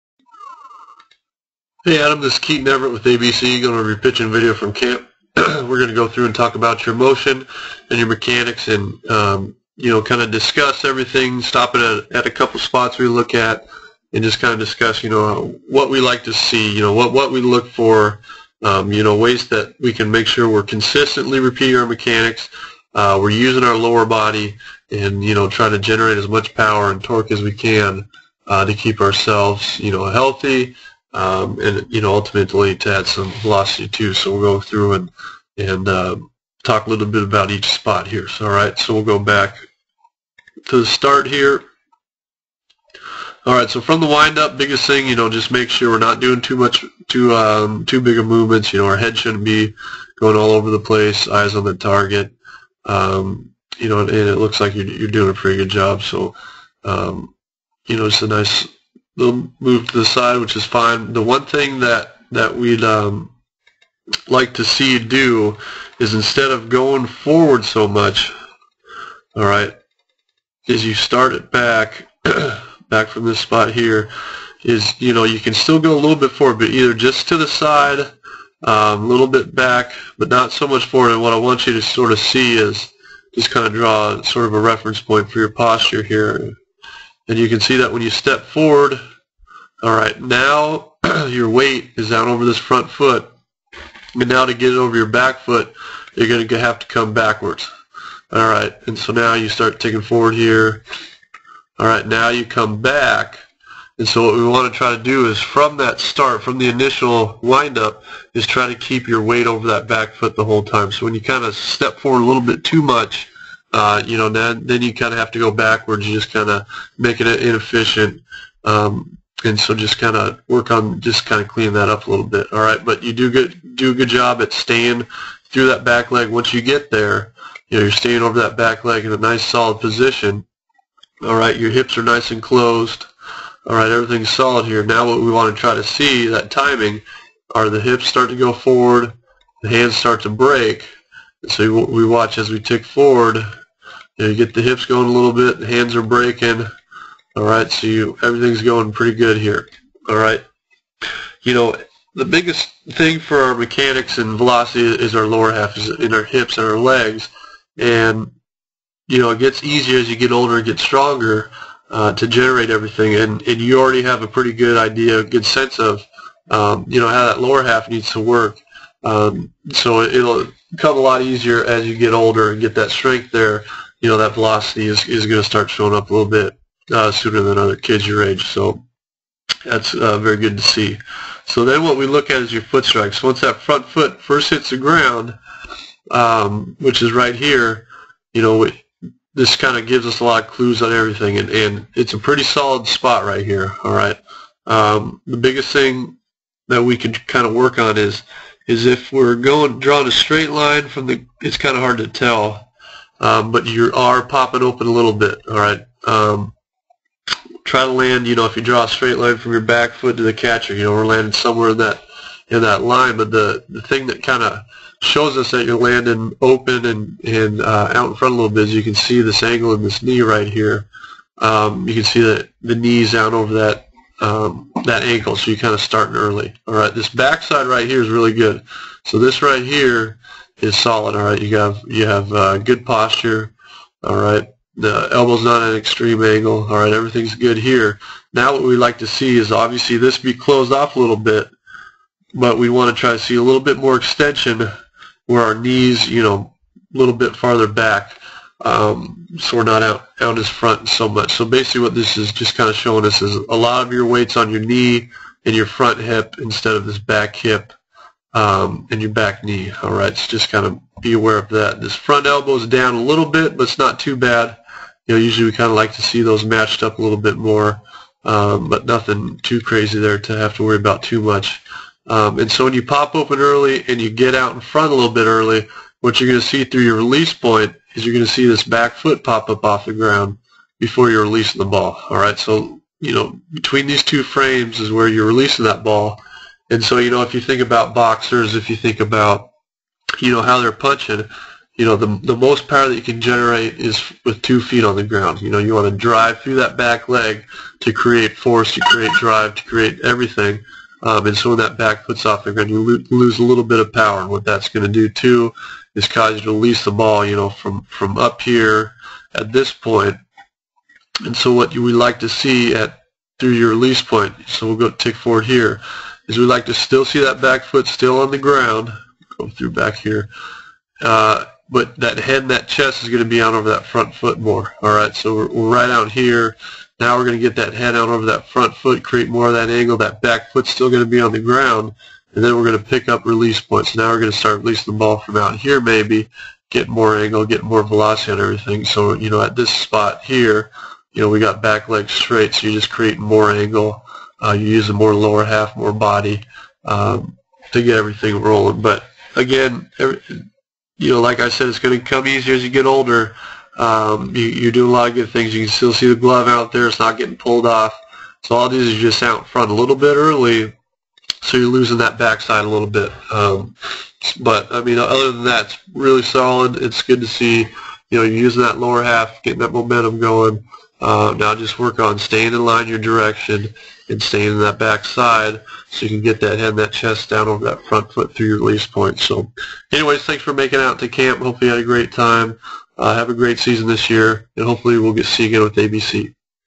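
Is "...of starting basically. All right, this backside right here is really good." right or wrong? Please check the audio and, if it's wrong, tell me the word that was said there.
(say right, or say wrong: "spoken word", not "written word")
wrong: "early", not "basically".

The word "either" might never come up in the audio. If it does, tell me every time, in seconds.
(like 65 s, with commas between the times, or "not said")
76 s.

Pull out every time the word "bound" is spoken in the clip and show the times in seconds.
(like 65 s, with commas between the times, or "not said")
not said.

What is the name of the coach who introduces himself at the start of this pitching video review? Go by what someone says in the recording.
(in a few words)
Keaton Everett.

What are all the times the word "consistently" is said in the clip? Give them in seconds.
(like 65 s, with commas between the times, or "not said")
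20 s.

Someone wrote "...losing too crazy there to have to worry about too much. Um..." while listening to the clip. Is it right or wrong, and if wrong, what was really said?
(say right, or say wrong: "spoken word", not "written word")
wrong: "nothing", not "losing".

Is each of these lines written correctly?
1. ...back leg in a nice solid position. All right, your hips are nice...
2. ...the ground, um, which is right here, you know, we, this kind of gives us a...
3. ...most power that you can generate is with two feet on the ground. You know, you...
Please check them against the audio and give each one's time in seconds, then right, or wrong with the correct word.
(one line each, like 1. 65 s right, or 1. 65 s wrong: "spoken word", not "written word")
1. 128 s right
2. 184 s right
3. 292 s right.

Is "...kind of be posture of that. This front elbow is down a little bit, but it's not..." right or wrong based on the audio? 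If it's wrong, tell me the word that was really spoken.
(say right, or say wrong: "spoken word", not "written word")
wrong: "aware", not "posture".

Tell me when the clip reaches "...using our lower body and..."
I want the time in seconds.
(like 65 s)
23 s.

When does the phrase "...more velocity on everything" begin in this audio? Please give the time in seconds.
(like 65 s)
337 s.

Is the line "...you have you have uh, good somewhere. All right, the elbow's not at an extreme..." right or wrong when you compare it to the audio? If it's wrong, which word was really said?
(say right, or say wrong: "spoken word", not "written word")
wrong: "posture", not "somewhere".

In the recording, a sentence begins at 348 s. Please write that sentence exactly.
But again, every, you know, like I said, it's going to come easier as you get older.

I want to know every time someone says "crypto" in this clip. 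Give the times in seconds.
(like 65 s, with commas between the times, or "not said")
not said.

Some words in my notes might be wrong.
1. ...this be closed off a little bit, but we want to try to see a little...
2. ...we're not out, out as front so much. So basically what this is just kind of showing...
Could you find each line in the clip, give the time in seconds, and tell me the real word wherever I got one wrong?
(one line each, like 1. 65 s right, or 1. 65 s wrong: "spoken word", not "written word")
1. 239 s right
2. 249 s right.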